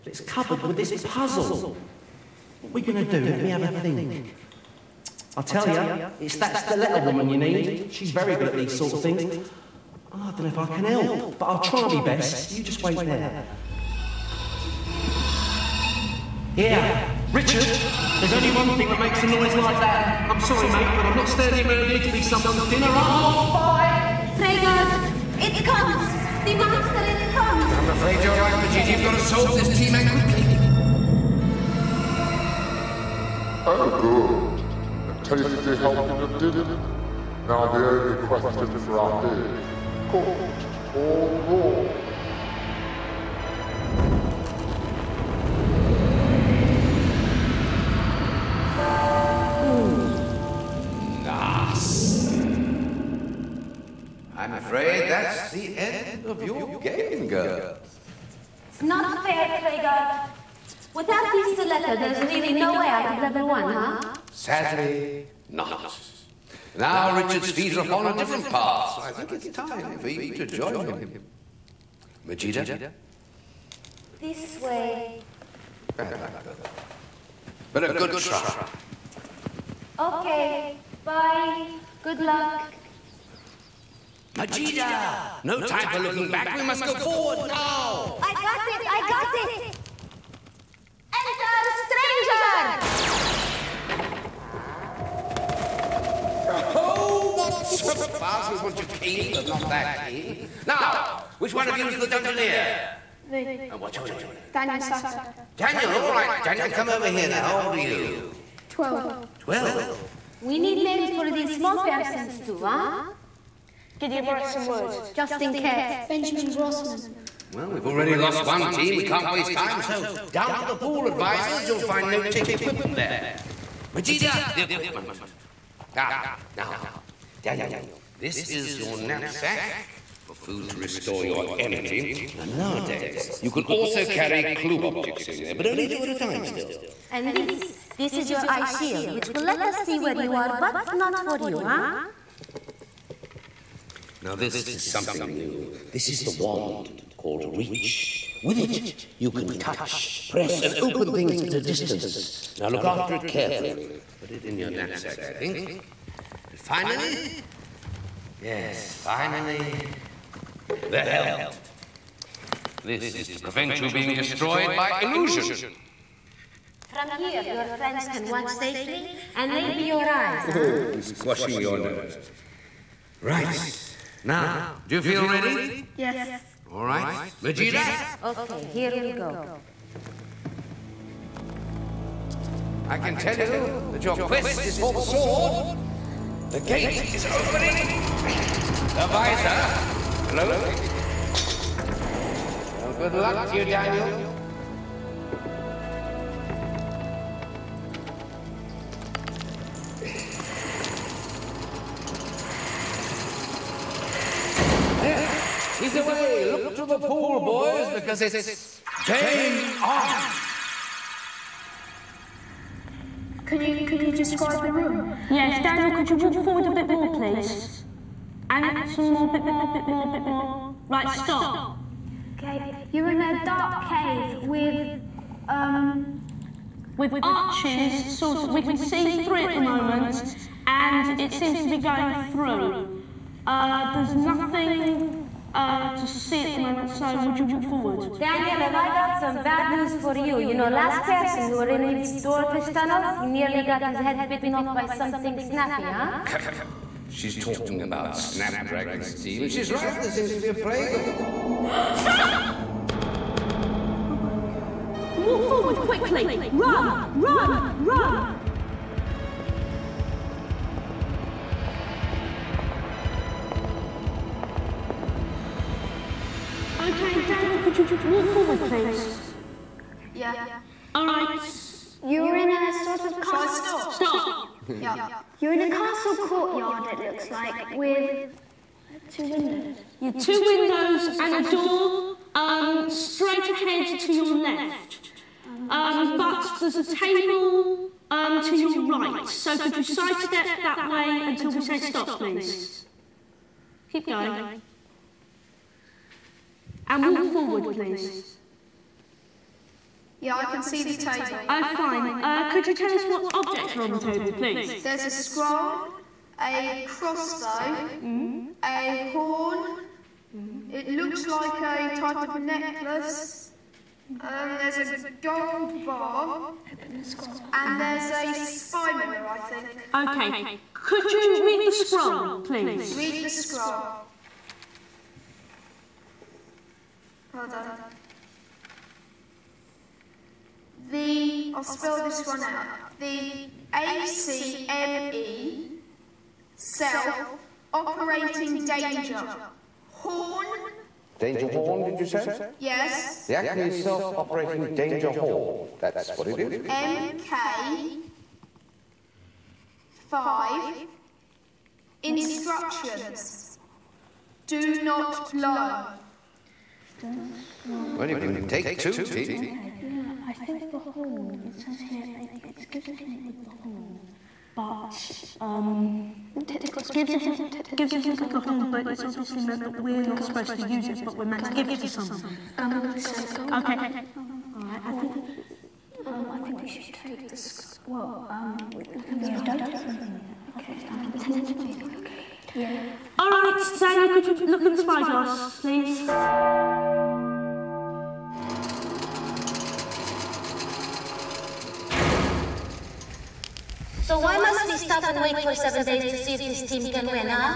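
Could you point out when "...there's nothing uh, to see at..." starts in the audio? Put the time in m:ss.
3:53.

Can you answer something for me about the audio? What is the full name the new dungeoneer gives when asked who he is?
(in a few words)
Daniel Saka.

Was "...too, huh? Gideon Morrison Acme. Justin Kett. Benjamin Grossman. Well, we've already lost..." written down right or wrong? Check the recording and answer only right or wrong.
wrong.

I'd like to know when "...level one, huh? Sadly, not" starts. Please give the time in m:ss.
1:03.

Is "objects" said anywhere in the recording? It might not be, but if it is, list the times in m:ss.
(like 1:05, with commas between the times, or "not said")
2:14, 5:03.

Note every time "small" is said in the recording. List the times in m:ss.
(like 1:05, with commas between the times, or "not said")
1:51.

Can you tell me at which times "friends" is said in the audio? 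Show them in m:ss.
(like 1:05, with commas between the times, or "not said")
2:47.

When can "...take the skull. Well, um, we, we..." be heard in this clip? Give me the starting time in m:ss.
6:16.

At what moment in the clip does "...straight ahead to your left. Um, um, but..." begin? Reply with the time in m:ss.
4:42.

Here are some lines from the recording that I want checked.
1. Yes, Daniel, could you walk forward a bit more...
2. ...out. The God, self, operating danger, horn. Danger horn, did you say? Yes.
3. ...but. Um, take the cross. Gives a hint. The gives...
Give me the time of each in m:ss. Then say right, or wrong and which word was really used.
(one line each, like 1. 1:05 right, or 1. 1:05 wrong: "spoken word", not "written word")
1. 3:35 right
2. 5:32 wrong: "ACME", not "God"
3. 6:04 right.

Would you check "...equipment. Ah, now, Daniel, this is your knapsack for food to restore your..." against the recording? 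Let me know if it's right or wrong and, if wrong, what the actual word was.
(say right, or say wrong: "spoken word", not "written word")
right.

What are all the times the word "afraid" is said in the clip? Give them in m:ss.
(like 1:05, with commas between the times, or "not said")
0:27, 0:54.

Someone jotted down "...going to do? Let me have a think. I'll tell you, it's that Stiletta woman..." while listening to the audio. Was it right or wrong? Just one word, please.
right.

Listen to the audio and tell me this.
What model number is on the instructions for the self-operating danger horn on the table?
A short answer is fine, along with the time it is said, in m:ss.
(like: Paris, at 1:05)
MK 5, at 5:46.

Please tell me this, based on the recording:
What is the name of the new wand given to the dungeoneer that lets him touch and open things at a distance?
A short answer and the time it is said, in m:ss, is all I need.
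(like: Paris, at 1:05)
Reach, at 2:27.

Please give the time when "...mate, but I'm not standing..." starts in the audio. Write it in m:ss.
0:20.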